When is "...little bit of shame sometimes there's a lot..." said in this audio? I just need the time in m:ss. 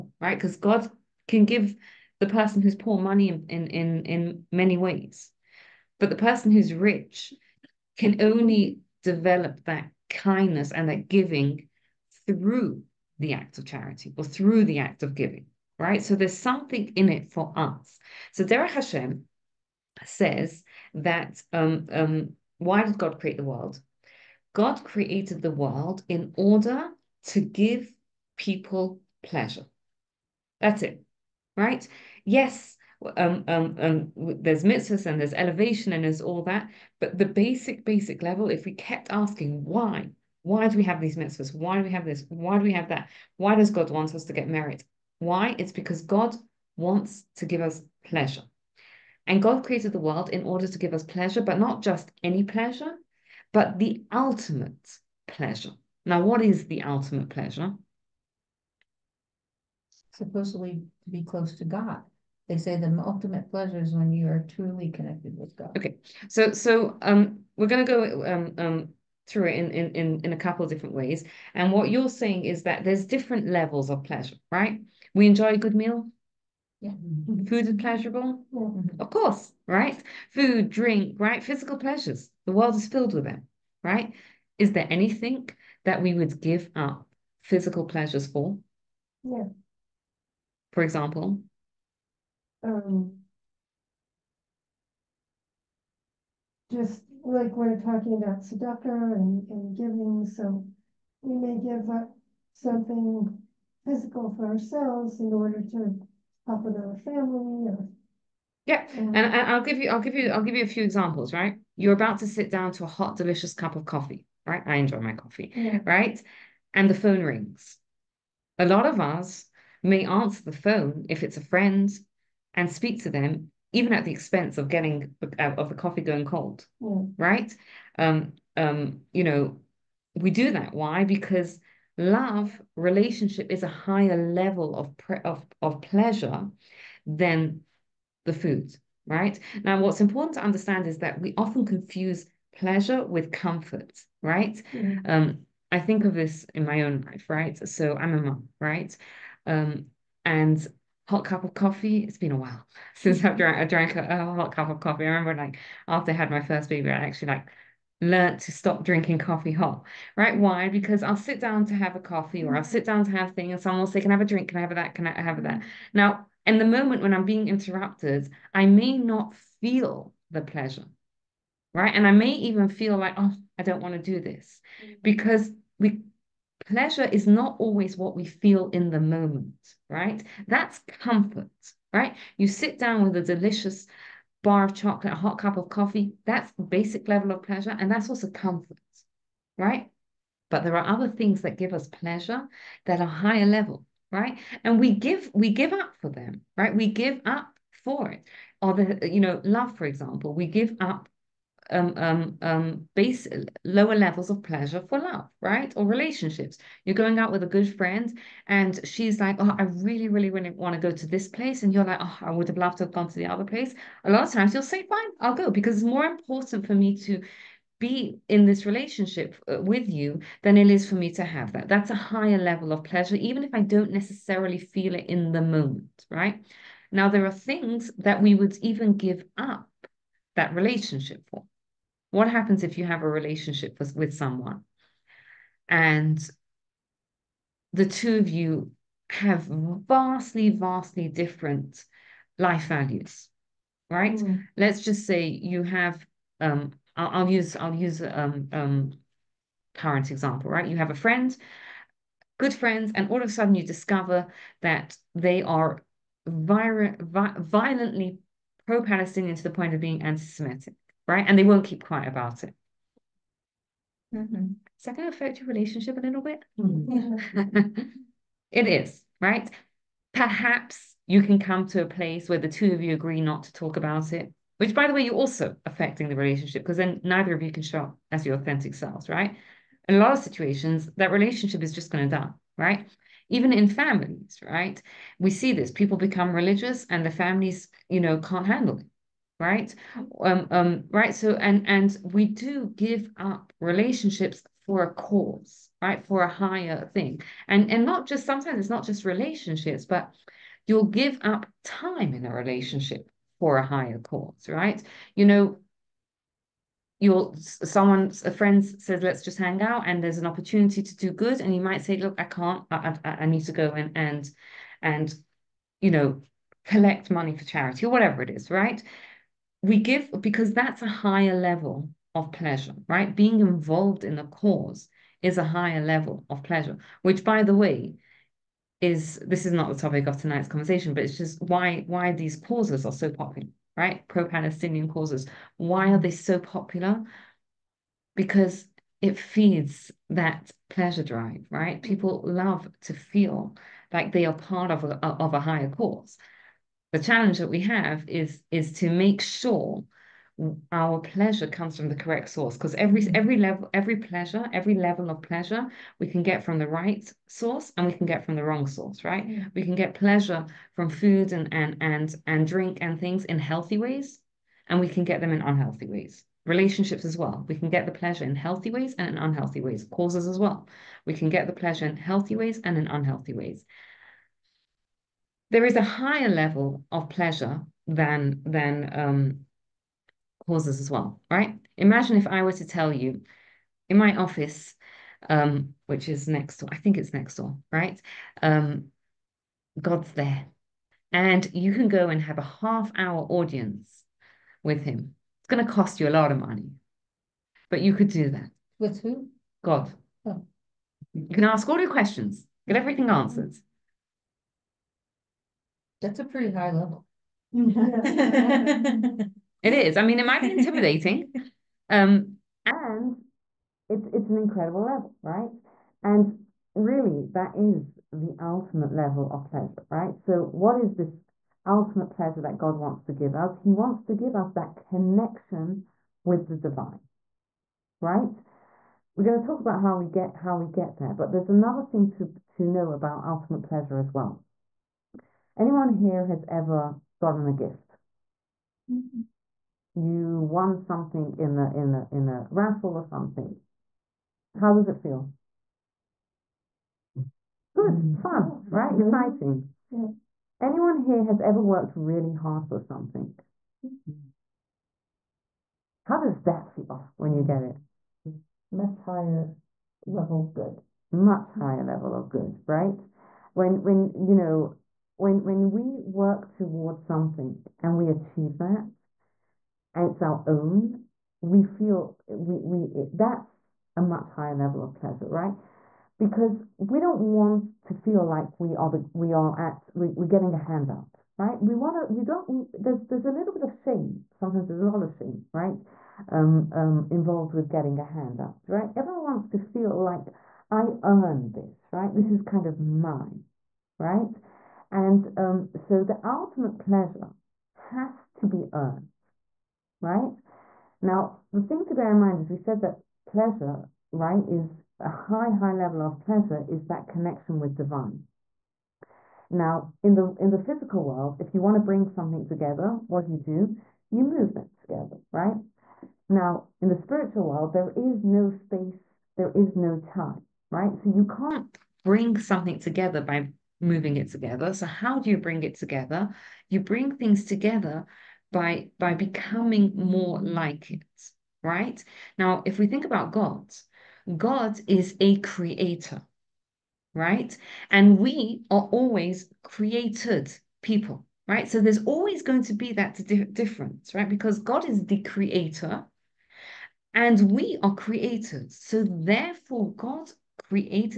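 8:03.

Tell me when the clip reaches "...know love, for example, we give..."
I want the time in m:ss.
3:19.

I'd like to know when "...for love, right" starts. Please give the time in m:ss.
3:24.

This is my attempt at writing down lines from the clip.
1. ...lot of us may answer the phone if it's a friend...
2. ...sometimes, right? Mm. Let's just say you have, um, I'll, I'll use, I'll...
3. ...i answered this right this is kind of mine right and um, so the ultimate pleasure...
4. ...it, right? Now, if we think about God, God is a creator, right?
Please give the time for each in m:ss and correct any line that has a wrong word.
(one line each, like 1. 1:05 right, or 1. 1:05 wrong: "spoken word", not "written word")
1. 1:58 right
2. 4:02 wrong: "values", not "sometimes"
3. 8:10 wrong: "earned", not "answered"
4. 8:50 right.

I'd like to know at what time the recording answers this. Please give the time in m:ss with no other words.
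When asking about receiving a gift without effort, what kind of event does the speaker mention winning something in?
7:22.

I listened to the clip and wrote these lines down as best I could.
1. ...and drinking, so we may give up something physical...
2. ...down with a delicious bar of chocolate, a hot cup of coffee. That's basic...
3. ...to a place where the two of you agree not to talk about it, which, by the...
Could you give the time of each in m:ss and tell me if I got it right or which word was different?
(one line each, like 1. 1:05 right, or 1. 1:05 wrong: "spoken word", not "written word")
1. 1:39 wrong: "giving", not "drinking"
2. 3:02 right
3. 4:31 right.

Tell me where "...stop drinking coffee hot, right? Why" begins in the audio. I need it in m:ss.
2:38.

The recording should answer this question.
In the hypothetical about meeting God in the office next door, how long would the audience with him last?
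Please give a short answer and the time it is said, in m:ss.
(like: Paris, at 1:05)
half hour, at 6:32.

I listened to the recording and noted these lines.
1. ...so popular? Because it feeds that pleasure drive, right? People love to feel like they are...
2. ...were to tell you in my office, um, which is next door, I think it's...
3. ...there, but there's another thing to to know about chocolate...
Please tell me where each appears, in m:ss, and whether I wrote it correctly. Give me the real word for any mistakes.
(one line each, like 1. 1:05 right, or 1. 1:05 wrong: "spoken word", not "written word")
1. 5:36 right
2. 6:22 right
3. 7:10 wrong: "ultimate", not "chocolate".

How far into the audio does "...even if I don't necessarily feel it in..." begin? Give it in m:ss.
3:43.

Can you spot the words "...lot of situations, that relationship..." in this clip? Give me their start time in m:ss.
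4:39.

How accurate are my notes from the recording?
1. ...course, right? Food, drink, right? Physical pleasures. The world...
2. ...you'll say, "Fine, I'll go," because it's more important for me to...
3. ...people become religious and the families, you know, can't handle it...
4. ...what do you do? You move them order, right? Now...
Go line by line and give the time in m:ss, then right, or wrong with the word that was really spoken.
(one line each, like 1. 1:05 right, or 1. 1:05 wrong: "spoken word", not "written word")
1. 1:19 right
2. 3:34 right
3. 4:45 right
4. 8:33 wrong: "together", not "order".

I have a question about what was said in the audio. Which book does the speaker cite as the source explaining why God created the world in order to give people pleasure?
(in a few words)
Derech Hashem.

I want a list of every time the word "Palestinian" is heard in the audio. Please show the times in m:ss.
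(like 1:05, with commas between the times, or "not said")
4:18, 5:34.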